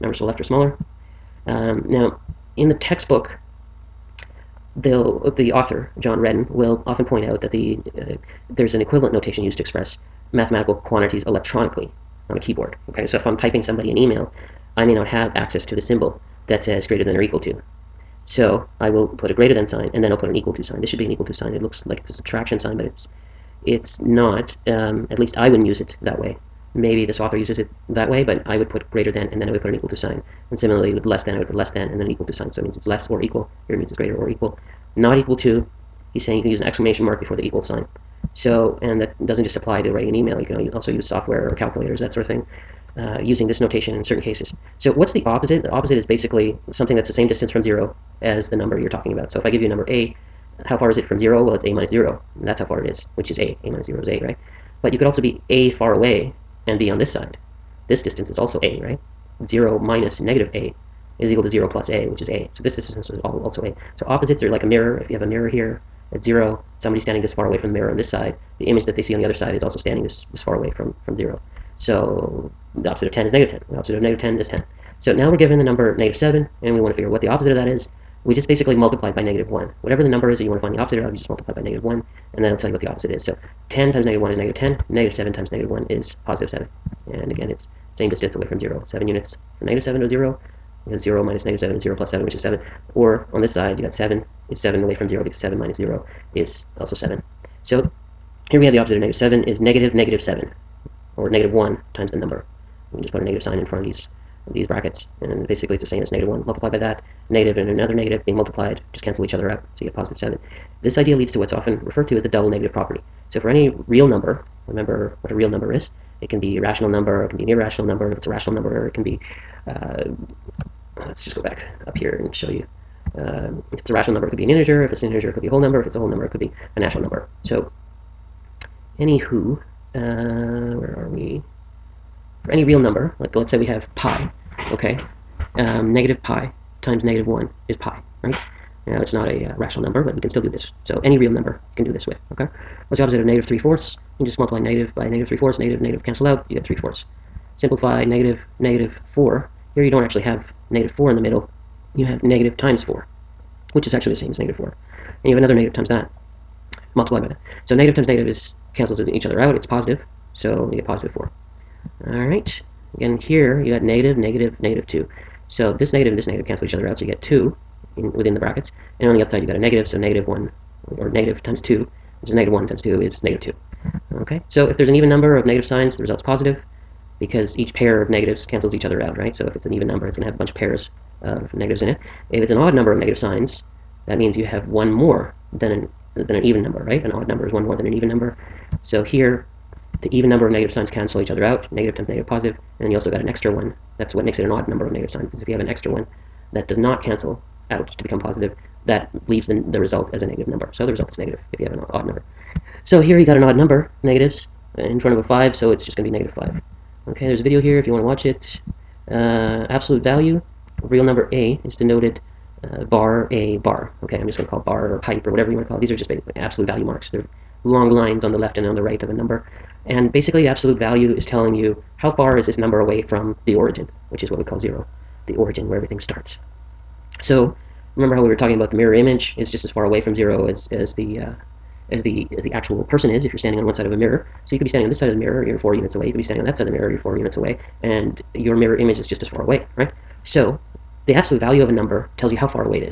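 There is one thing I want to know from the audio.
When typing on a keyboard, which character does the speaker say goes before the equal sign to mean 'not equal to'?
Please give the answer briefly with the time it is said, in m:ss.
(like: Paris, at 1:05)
exclamation mark, at 0:36.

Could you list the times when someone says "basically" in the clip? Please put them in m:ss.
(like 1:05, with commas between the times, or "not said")
0:46, 1:18, 1:45, 3:40.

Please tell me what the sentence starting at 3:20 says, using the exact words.
So the result is negative if you have an odd number.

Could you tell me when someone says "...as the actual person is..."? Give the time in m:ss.
3:52.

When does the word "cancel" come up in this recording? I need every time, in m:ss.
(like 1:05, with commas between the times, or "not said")
1:49, 2:26, 2:38, 2:46, 2:58, 3:10, 3:17.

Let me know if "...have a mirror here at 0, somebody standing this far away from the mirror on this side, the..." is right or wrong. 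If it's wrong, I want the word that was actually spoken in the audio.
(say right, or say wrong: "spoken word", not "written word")
right.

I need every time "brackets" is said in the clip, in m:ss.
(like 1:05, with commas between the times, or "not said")
1:44, 2:48.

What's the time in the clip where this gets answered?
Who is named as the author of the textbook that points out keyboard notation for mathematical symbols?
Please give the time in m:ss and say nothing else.
0:05.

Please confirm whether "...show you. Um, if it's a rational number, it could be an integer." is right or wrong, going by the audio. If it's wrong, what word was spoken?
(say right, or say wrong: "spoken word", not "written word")
right.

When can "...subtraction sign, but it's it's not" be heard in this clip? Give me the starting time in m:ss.
0:22.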